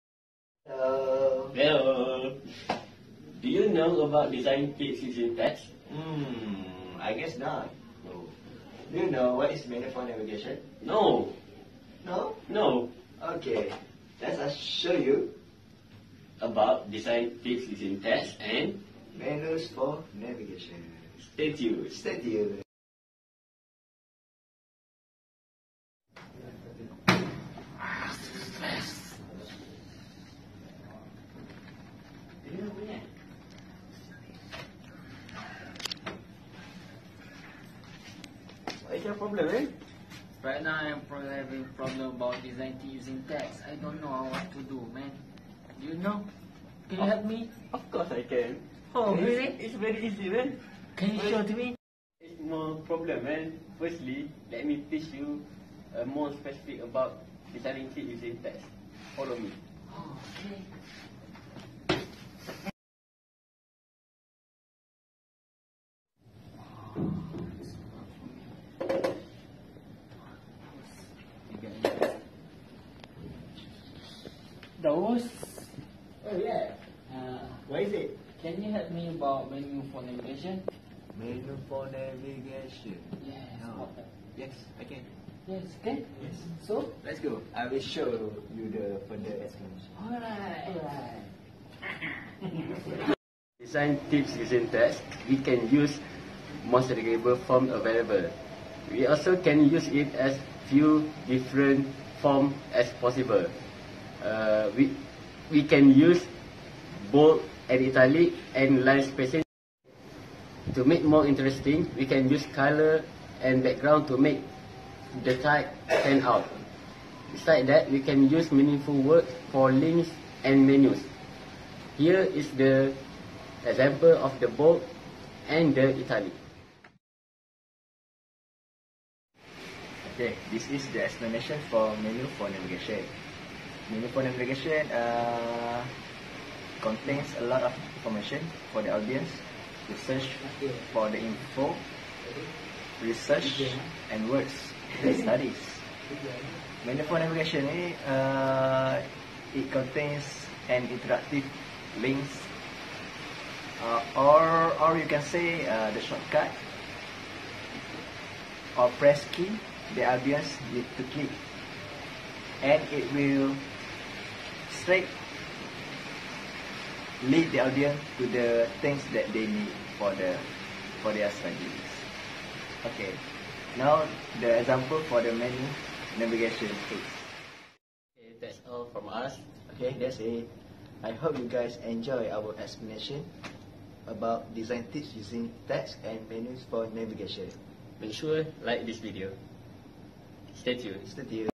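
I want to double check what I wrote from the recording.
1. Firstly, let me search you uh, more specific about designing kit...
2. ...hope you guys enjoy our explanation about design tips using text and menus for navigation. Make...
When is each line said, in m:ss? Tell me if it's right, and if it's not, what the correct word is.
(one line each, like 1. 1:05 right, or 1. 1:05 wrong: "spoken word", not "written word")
1. 0:53 wrong: "teach", not "search"
2. 3:01 right.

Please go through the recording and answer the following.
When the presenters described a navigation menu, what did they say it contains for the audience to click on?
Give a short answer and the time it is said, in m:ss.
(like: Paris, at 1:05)
Interactive links, at 2:30.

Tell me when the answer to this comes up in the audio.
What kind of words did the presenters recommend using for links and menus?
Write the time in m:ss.
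1:58.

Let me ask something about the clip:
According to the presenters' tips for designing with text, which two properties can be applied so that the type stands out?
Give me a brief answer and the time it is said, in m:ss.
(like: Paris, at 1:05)
Color and background, at 1:52.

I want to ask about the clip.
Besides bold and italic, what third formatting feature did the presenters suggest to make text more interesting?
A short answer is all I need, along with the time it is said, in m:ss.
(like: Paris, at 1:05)
Line spacing, at 1:48.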